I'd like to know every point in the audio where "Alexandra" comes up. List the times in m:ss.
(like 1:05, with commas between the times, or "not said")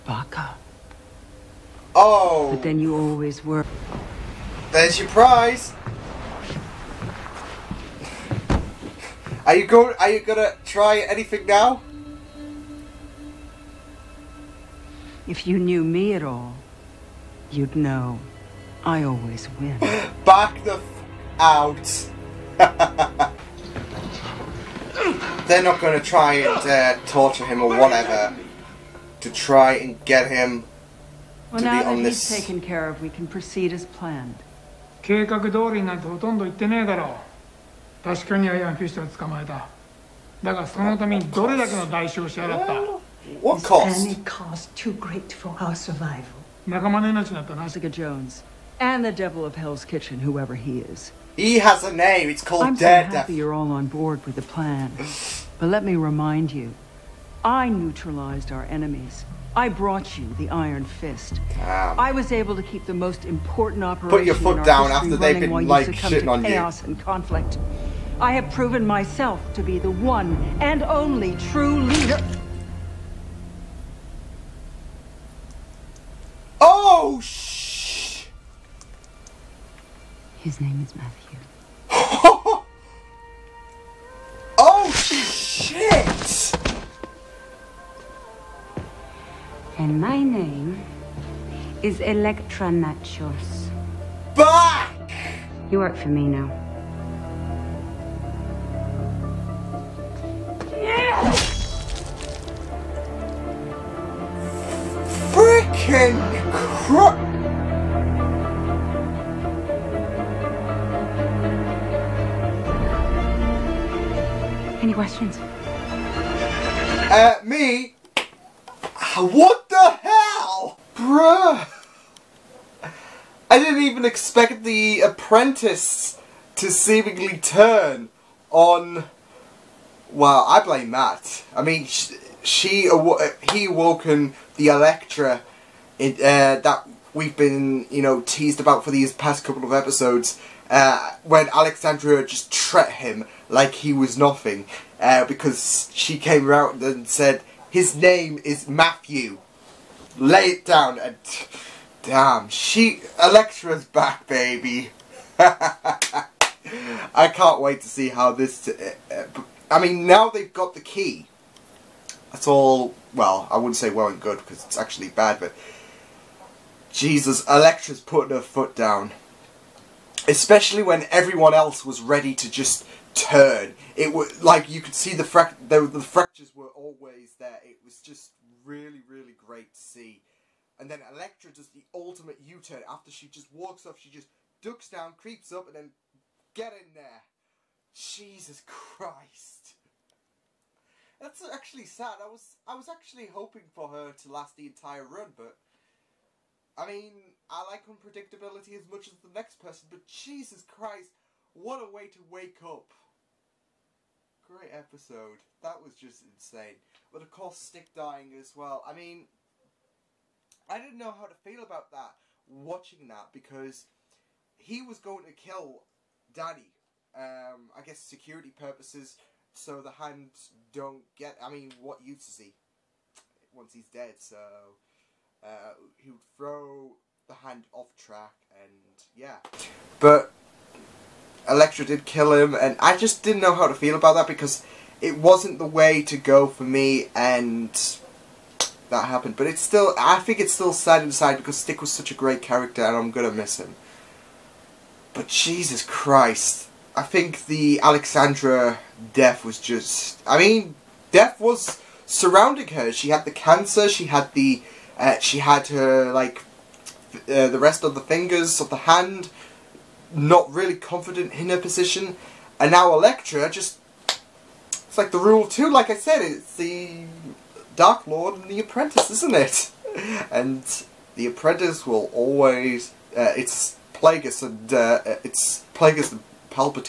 2:21, 4:07.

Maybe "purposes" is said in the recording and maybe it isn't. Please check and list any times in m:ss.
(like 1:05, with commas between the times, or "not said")
3:38.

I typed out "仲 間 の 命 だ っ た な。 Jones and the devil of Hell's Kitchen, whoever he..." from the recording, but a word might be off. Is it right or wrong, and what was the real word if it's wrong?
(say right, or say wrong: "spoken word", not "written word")
right.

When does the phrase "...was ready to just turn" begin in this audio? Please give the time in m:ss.
2:51.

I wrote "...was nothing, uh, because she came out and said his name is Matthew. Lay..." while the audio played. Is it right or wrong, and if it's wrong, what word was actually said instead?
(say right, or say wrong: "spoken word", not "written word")
right.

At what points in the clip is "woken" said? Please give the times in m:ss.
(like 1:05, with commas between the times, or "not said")
2:13.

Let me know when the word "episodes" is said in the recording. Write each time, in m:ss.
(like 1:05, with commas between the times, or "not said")
2:19, 3:24.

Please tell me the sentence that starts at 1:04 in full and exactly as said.
Put your foot down after they've been like shitting on chaos you.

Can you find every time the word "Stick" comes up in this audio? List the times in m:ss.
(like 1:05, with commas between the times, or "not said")
3:27, 4:01.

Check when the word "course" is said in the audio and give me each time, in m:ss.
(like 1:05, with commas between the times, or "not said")
3:27.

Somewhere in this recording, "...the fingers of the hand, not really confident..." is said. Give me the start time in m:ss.
4:17.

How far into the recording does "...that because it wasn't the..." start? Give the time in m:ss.
3:54.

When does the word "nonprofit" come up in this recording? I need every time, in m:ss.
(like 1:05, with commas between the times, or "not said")
not said.